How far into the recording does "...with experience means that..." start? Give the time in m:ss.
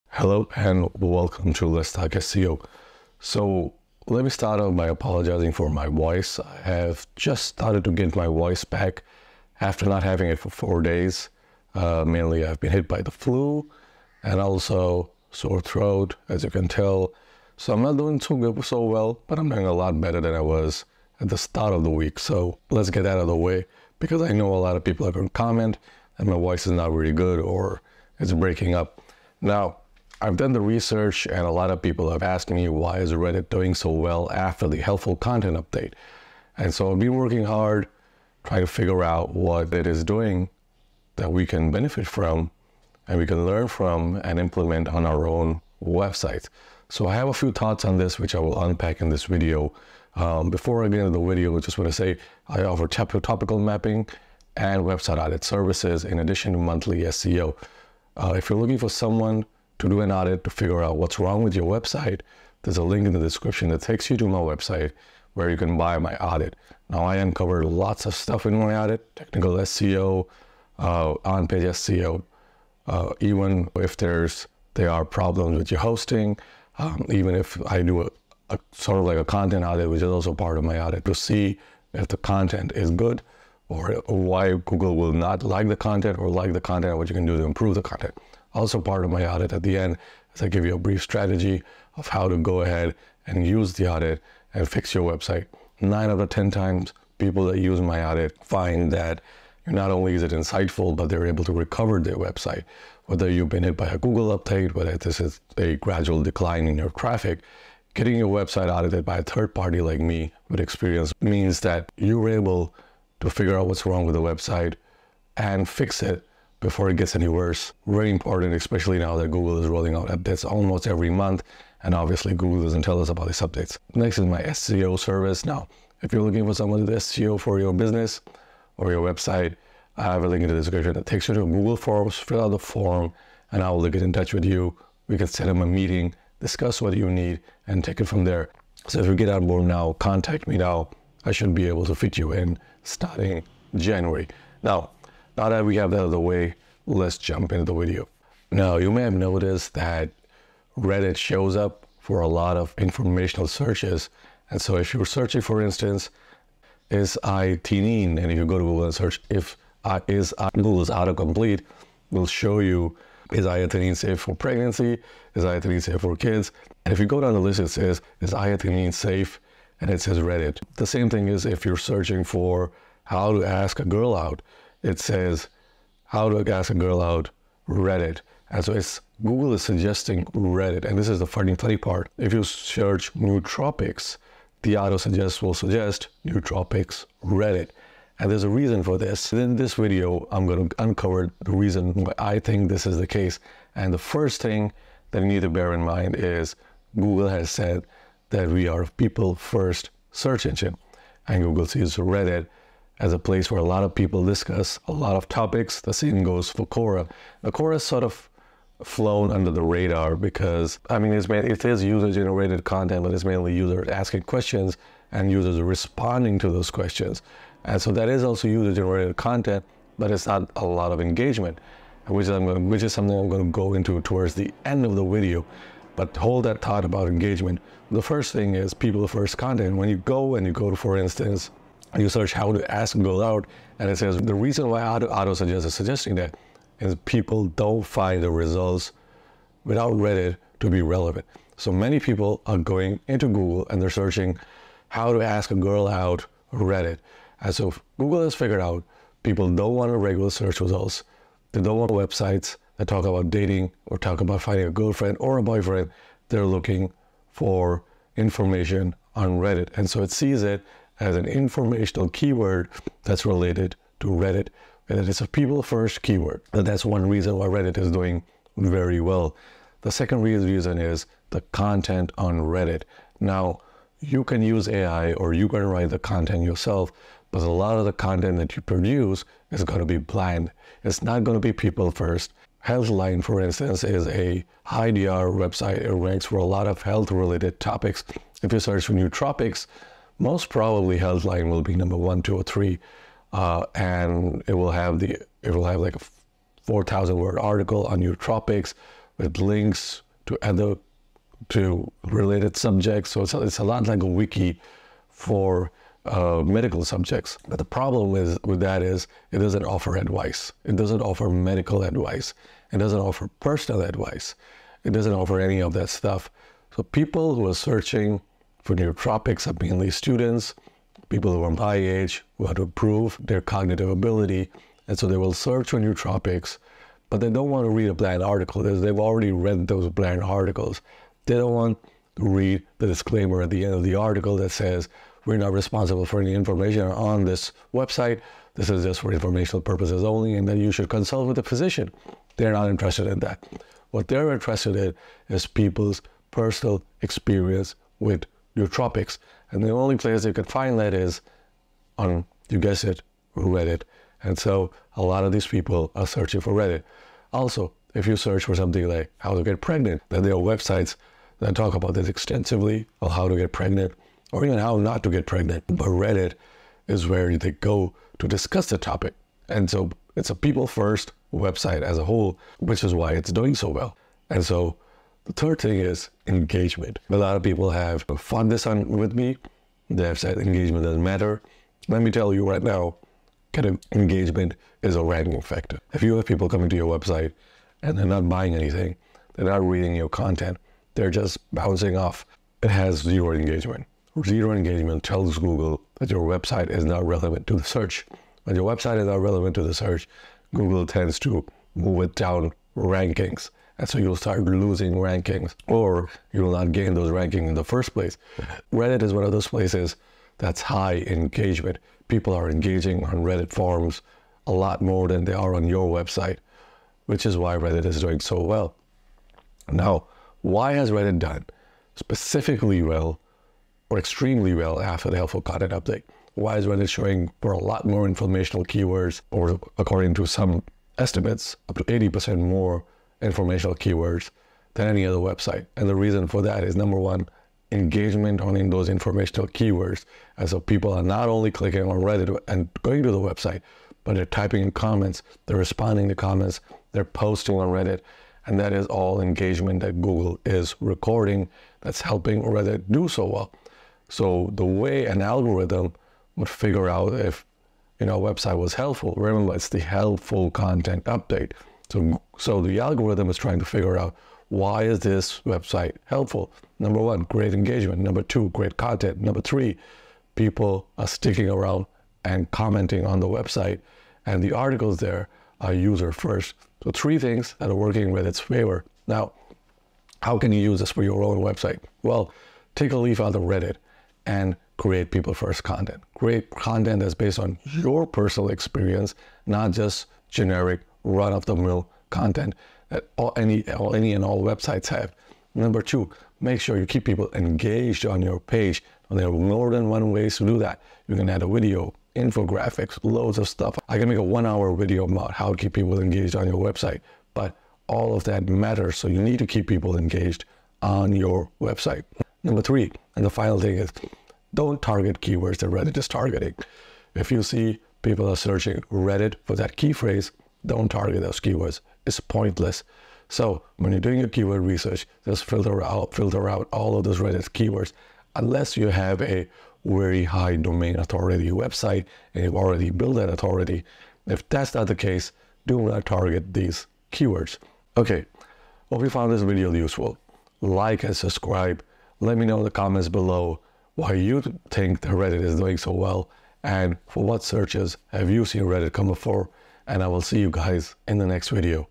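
1:50.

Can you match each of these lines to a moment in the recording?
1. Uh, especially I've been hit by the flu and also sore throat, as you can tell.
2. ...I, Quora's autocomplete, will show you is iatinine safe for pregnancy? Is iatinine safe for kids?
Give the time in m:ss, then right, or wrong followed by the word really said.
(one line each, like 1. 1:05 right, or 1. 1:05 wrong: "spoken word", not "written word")
1. 0:11 wrong: "mainly", not "especially"
2. 2:40 wrong: "Google", not "Quora".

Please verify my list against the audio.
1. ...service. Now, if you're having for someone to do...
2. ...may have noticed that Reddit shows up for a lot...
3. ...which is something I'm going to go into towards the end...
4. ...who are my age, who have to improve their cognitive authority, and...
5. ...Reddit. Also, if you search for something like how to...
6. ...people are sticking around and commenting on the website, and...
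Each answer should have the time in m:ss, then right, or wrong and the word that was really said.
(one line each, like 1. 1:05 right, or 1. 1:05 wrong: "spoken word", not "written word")
1. 2:04 wrong: "looking", not "having"
2. 2:28 right
3. 3:42 right
4. 5:21 wrong: "ability", not "authority"
5. 5:56 right
6. 7:50 right.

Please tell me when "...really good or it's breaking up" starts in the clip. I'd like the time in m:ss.
0:26.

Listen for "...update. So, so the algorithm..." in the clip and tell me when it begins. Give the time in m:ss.
7:41.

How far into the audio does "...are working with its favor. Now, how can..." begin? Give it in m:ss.
7:57.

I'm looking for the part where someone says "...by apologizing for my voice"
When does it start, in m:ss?
0:04.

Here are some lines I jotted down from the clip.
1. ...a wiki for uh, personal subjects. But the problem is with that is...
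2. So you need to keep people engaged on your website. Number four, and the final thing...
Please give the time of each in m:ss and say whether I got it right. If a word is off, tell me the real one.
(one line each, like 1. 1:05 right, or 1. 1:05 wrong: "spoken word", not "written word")
1. 5:04 wrong: "medical", not "personal"
2. 8:28 wrong: "three", not "four".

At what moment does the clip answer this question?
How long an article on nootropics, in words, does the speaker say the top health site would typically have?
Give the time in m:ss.
4:56.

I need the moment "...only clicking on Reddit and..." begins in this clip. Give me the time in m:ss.
7:21.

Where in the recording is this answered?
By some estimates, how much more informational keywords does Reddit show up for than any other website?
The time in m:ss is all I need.
7:11.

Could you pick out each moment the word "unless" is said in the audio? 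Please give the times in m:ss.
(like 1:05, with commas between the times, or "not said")
8:48.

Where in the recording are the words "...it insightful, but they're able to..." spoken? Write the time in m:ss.
1:40.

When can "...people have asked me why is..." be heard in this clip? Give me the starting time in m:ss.
0:31.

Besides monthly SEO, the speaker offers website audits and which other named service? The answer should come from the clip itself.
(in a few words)
topical mapping.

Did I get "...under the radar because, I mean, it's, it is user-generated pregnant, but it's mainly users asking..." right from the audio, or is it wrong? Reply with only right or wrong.
wrong.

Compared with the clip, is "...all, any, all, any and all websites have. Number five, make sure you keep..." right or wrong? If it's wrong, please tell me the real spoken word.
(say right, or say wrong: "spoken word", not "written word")
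wrong: "two", not "five".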